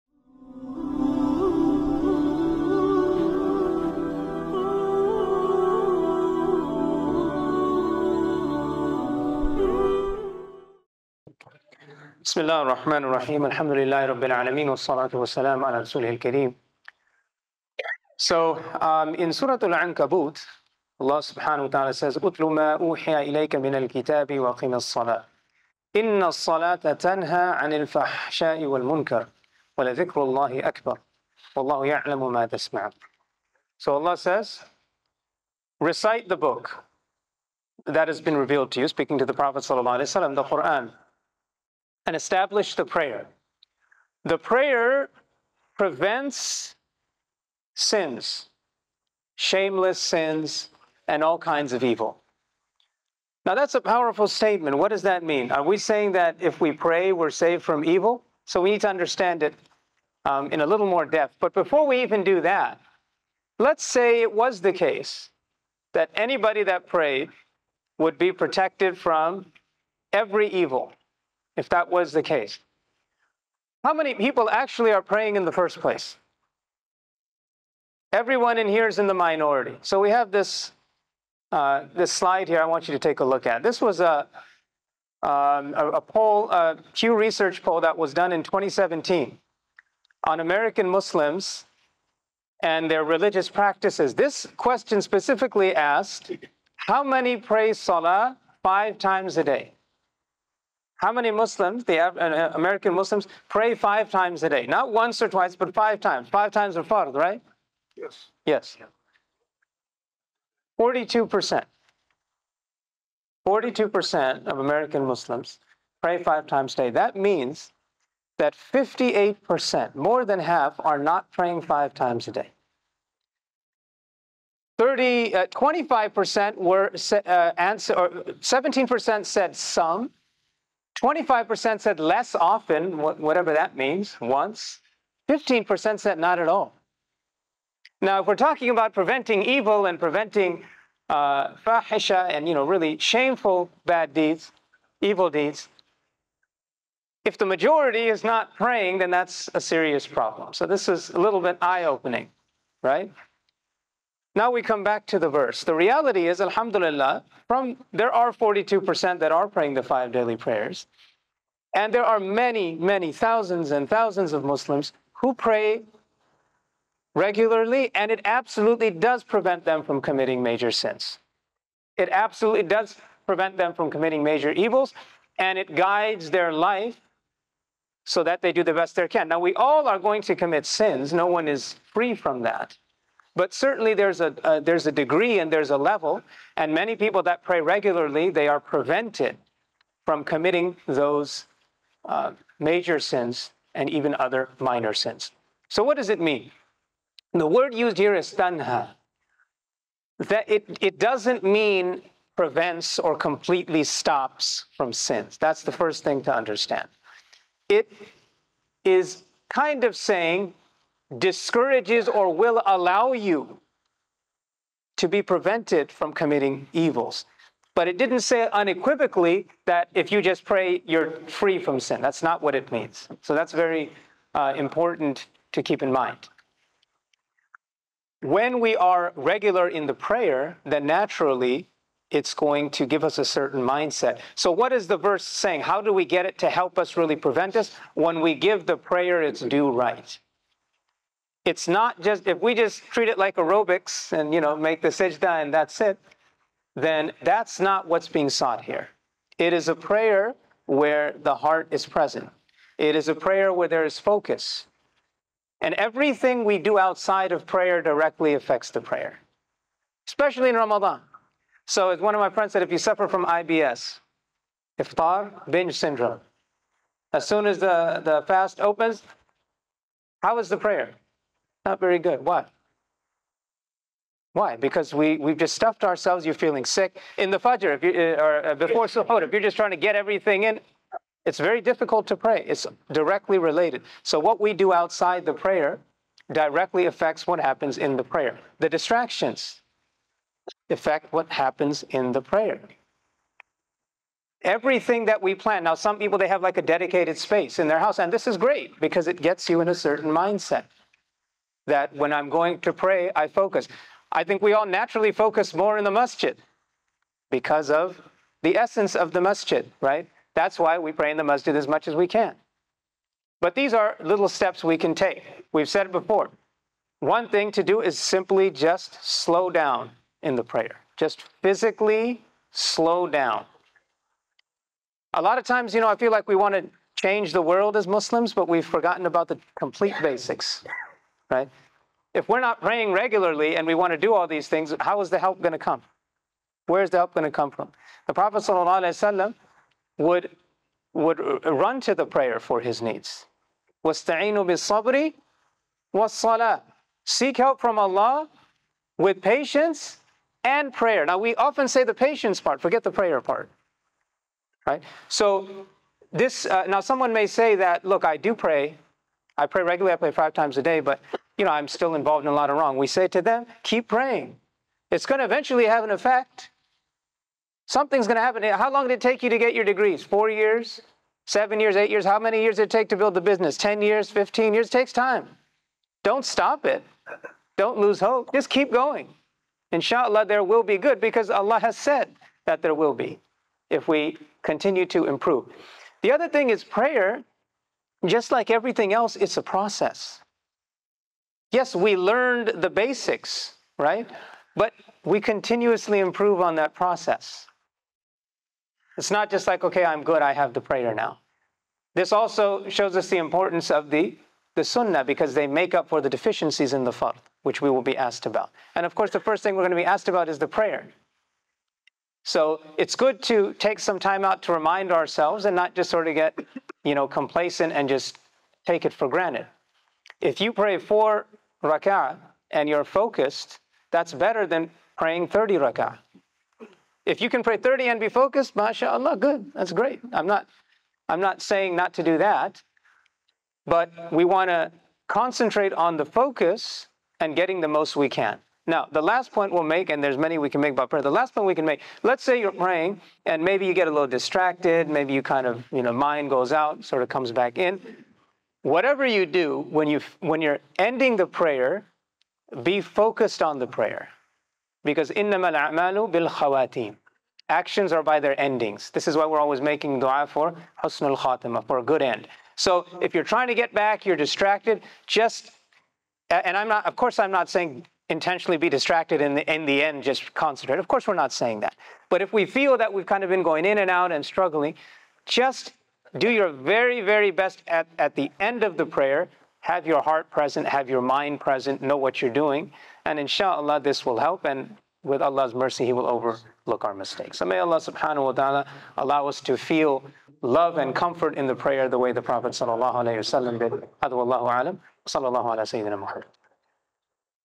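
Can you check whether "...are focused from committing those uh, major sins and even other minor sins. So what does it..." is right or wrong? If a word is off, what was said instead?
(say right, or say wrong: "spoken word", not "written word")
wrong: "prevented", not "focused".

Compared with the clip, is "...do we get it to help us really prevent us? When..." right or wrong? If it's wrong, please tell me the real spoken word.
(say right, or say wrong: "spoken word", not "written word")
right.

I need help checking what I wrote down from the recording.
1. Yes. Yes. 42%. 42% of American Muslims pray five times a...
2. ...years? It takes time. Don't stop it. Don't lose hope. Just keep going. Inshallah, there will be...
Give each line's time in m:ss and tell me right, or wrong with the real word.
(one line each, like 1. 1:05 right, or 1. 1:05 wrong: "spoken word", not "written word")
1. 1:47 right
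2. 6:14 right.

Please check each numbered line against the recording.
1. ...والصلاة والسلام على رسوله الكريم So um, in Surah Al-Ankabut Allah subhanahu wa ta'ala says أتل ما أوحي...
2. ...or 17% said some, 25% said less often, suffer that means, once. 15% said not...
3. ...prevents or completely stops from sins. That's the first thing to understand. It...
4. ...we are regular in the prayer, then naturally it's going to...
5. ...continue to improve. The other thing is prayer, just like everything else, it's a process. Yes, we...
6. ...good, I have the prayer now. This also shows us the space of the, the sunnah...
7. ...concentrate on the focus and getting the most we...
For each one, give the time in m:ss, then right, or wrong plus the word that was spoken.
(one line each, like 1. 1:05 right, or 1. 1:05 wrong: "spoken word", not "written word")
1. 0:14 right
2. 2:07 wrong: "whatever", not "suffer"
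3. 3:22 right
4. 3:48 right
5. 6:24 right
6. 6:40 wrong: "importance", not "space"
7. 7:15 right.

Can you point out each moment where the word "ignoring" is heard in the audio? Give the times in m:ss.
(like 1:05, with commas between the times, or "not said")
not said.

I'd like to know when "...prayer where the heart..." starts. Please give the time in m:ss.
4:09.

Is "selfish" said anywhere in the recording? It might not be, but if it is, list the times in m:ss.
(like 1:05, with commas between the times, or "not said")
not said.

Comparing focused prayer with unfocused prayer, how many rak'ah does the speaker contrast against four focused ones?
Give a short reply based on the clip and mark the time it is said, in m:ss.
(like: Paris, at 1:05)
30, at 7:05.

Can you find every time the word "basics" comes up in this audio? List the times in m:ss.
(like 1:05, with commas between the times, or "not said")
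5:30, 6:32.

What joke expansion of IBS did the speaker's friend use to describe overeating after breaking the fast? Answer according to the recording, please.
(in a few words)
iftar binge syndrome.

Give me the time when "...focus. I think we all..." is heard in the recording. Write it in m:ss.
5:03.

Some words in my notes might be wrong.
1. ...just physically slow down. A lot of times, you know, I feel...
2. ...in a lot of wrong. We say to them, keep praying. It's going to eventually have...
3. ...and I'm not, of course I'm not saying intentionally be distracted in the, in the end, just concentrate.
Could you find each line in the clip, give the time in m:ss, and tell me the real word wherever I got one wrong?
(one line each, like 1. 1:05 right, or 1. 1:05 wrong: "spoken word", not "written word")
1. 5:20 right
2. 6:02 right
3. 7:46 right.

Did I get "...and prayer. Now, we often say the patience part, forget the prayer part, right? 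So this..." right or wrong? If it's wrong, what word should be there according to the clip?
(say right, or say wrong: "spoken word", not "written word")
right.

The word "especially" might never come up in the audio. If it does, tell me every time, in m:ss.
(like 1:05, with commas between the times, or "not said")
4:20.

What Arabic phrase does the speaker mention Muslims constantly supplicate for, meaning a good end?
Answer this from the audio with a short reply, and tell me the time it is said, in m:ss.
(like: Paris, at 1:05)
husnul khatima, at 7:40.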